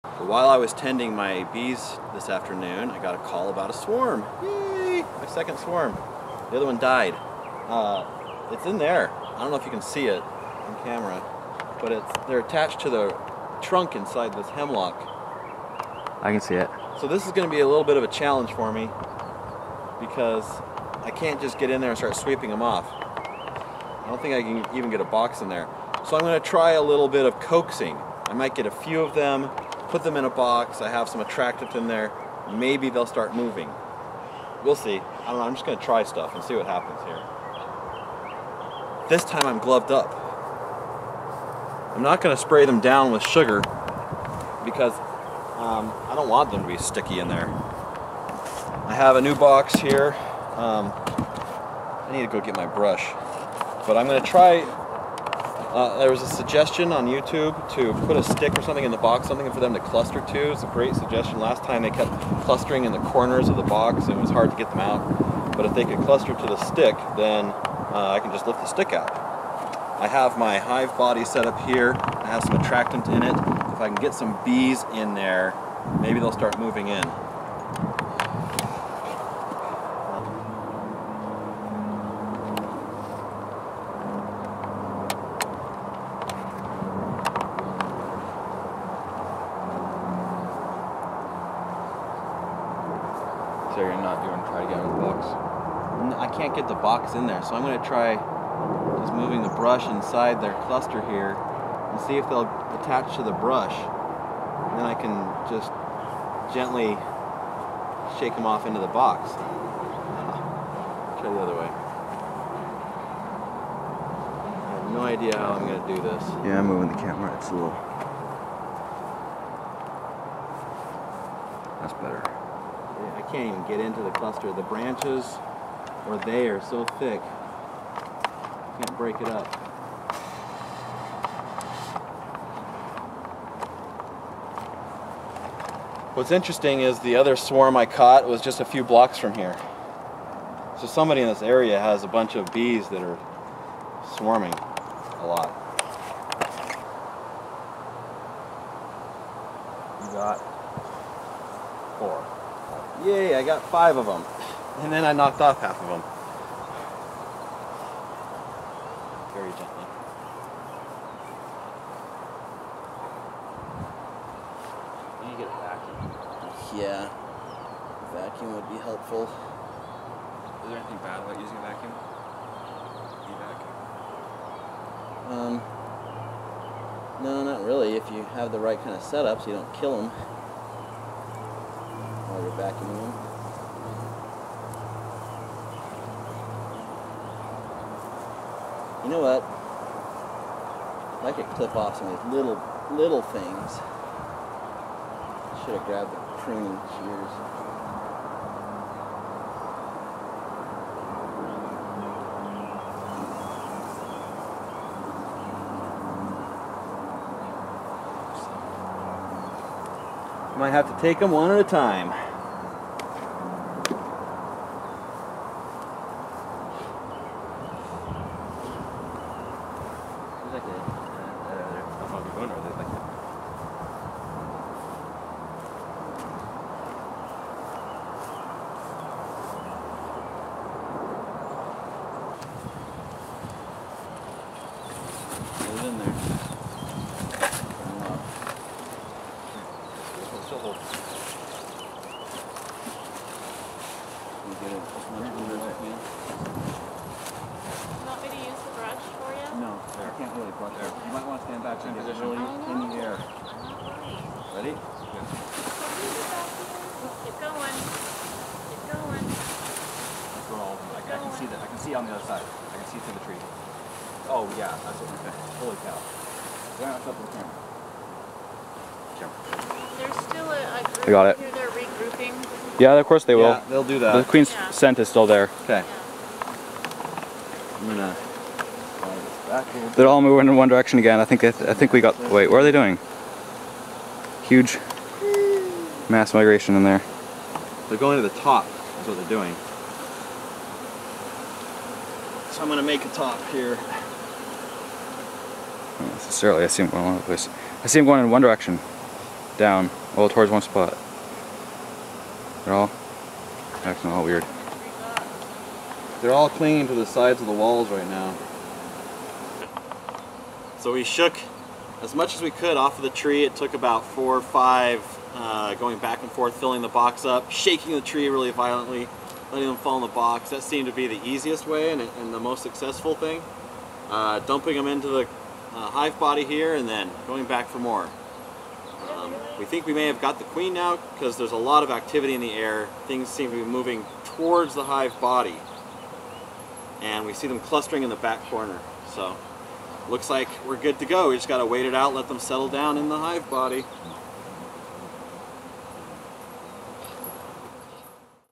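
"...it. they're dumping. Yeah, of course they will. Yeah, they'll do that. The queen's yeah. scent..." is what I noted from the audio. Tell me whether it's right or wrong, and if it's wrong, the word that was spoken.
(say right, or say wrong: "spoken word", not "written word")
wrong: "regrouping", not "dumping".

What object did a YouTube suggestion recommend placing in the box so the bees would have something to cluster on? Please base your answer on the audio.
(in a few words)
A stick.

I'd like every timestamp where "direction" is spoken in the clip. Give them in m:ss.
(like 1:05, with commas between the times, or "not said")
4:40, 4:58.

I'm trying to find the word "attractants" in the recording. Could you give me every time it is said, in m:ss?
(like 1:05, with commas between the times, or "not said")
0:31, 1:12.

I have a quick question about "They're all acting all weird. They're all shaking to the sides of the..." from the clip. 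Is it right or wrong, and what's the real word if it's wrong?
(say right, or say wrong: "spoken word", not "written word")
wrong: "clinging", not "shaking".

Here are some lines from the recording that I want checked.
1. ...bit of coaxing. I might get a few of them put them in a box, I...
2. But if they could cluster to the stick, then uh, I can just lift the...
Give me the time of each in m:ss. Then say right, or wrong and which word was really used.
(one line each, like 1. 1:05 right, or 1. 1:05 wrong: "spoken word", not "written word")
1. 0:27 right
2. 1:05 right.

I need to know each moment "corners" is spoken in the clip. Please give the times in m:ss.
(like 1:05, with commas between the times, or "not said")
1:02, 5:38.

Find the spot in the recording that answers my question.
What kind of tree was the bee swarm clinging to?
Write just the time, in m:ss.
0:14.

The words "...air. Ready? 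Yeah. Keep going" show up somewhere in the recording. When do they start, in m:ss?
4:13.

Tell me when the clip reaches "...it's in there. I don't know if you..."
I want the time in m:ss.
0:08.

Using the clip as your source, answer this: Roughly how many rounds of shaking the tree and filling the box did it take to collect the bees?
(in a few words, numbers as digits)
4 or 5.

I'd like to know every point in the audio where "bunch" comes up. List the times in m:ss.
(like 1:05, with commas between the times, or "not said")
2:22.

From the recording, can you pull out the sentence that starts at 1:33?
there and not doing try to get in the box?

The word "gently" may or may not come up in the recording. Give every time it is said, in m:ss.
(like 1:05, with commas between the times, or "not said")
1:46, 2:39.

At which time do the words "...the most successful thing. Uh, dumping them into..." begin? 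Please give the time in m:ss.
5:22.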